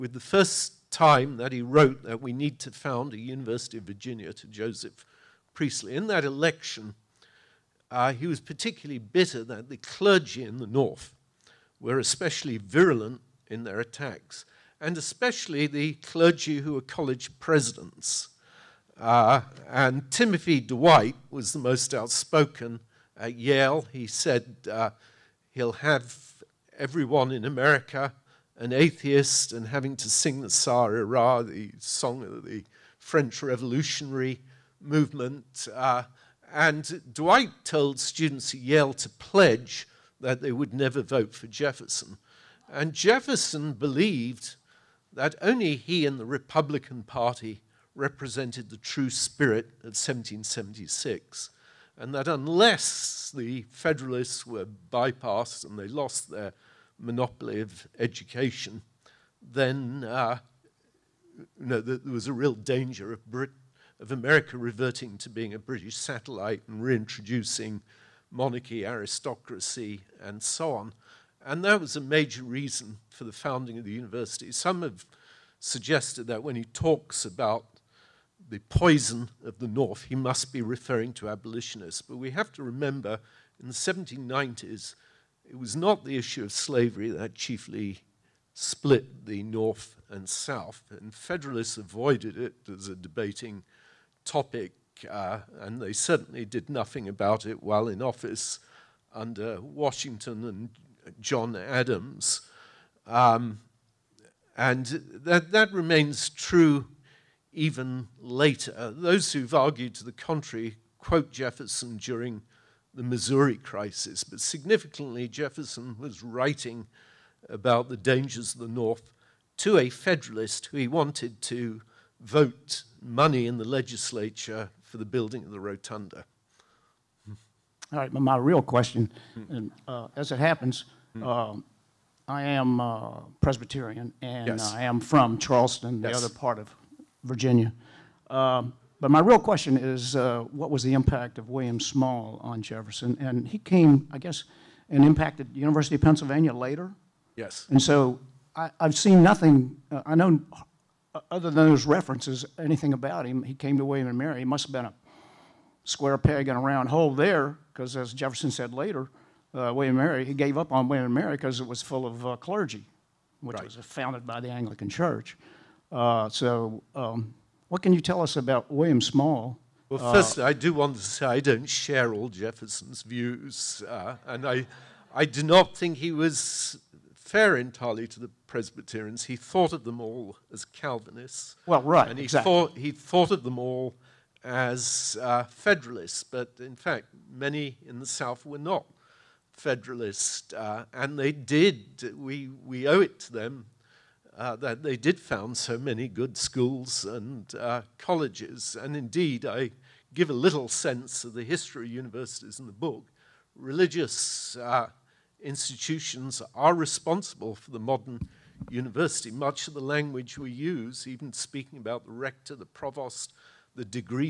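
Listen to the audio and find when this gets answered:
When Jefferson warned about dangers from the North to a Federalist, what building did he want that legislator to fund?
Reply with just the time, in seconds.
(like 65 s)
125 s.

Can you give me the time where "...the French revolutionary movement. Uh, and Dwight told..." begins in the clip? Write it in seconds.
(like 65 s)
32 s.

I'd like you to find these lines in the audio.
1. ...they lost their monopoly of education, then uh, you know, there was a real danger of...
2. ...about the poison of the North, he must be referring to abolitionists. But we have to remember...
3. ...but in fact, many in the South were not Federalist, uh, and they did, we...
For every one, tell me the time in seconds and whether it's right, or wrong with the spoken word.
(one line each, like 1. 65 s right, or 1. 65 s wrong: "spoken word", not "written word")
1. 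55 s right
2. 77 s right
3. 186 s right.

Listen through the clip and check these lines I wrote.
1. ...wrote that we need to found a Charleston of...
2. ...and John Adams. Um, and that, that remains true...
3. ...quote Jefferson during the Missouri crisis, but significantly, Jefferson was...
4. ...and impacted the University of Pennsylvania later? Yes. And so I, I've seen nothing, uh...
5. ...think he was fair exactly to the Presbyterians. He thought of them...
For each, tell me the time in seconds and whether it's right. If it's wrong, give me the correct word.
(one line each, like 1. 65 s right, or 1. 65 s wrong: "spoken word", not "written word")
1. 1 s wrong: "University", not "Charleston"
2. 100 s right
3. 110 s right
4. 144 s right
5. 175 s wrong: "entirely", not "exactly".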